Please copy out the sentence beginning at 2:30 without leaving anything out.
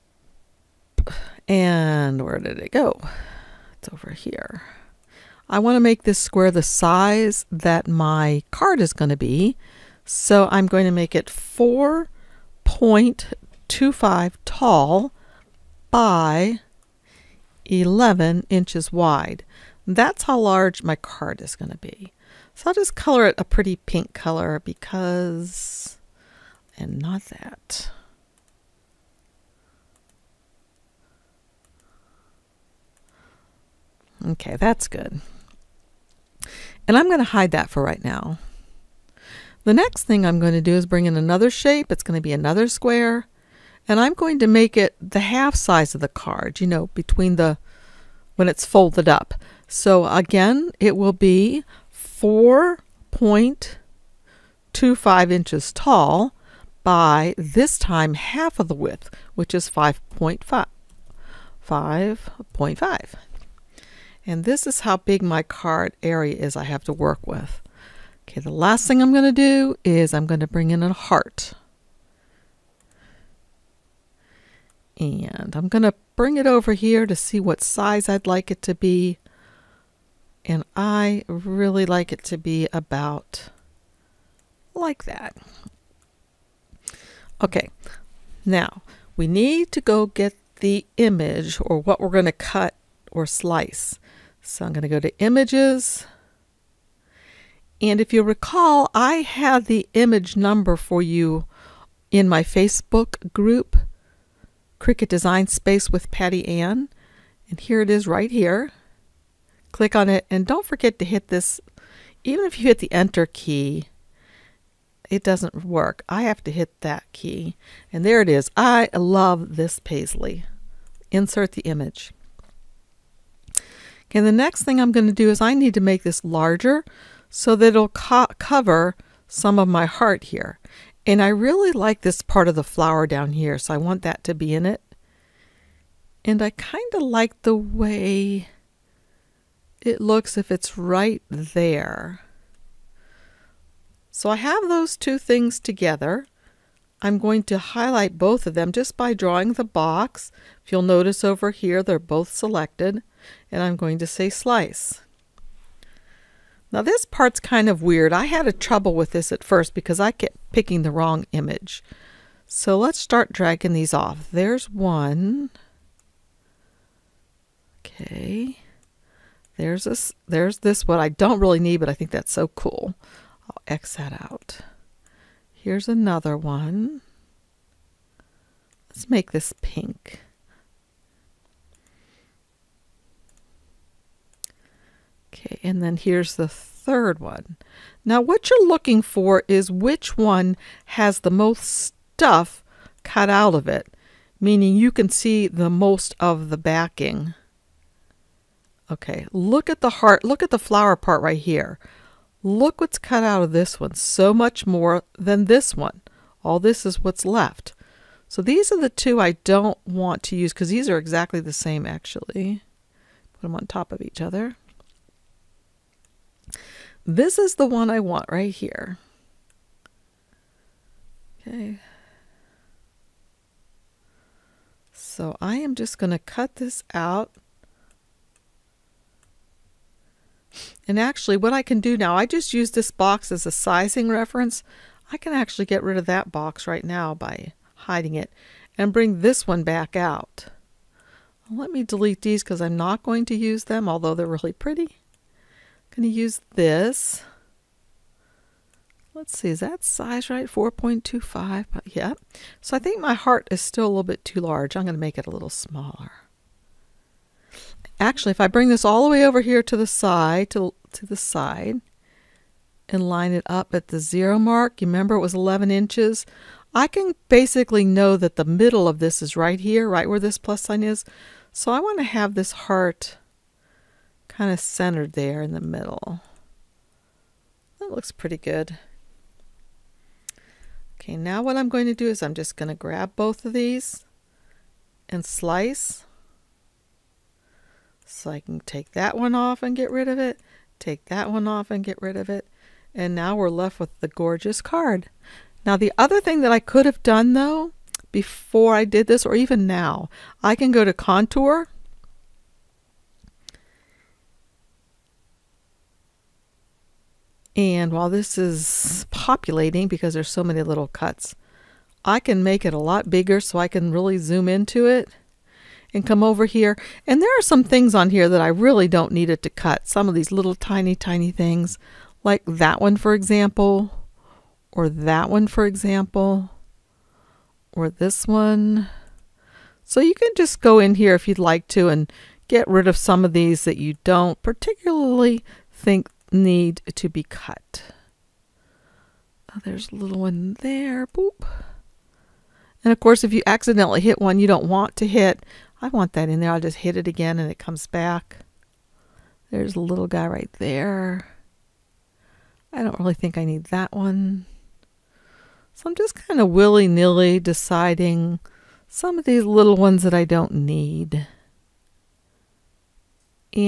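If you'll notice over here, they're both selected.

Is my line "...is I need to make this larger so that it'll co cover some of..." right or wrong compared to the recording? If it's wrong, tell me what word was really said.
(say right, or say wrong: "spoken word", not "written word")
right.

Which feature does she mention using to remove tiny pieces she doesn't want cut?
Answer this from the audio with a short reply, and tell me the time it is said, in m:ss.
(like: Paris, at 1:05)
Contour, at 5:00.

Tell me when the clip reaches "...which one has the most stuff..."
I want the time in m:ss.
3:09.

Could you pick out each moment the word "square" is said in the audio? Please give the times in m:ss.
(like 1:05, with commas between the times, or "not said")
0:06, 0:42.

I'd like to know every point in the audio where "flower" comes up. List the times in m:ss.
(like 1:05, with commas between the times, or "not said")
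2:12, 3:20.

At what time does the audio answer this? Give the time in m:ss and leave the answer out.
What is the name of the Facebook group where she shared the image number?
1:44.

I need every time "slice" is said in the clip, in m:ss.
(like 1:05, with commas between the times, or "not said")
1:33, 2:34, 4:45.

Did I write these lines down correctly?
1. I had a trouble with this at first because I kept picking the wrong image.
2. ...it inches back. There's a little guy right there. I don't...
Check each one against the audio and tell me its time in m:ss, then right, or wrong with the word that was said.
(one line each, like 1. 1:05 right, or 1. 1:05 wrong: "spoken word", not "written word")
1. 2:38 right
2. 5:47 wrong: "comes", not "inches".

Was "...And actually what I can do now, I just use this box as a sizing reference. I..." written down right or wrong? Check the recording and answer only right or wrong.
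right.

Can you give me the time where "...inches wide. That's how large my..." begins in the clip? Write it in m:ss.
0:18.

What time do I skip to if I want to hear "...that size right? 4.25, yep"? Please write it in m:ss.
4:09.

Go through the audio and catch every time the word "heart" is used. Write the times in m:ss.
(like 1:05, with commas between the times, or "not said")
1:10, 2:09, 3:19, 4:13, 4:32.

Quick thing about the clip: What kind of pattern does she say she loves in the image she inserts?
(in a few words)
Paisley.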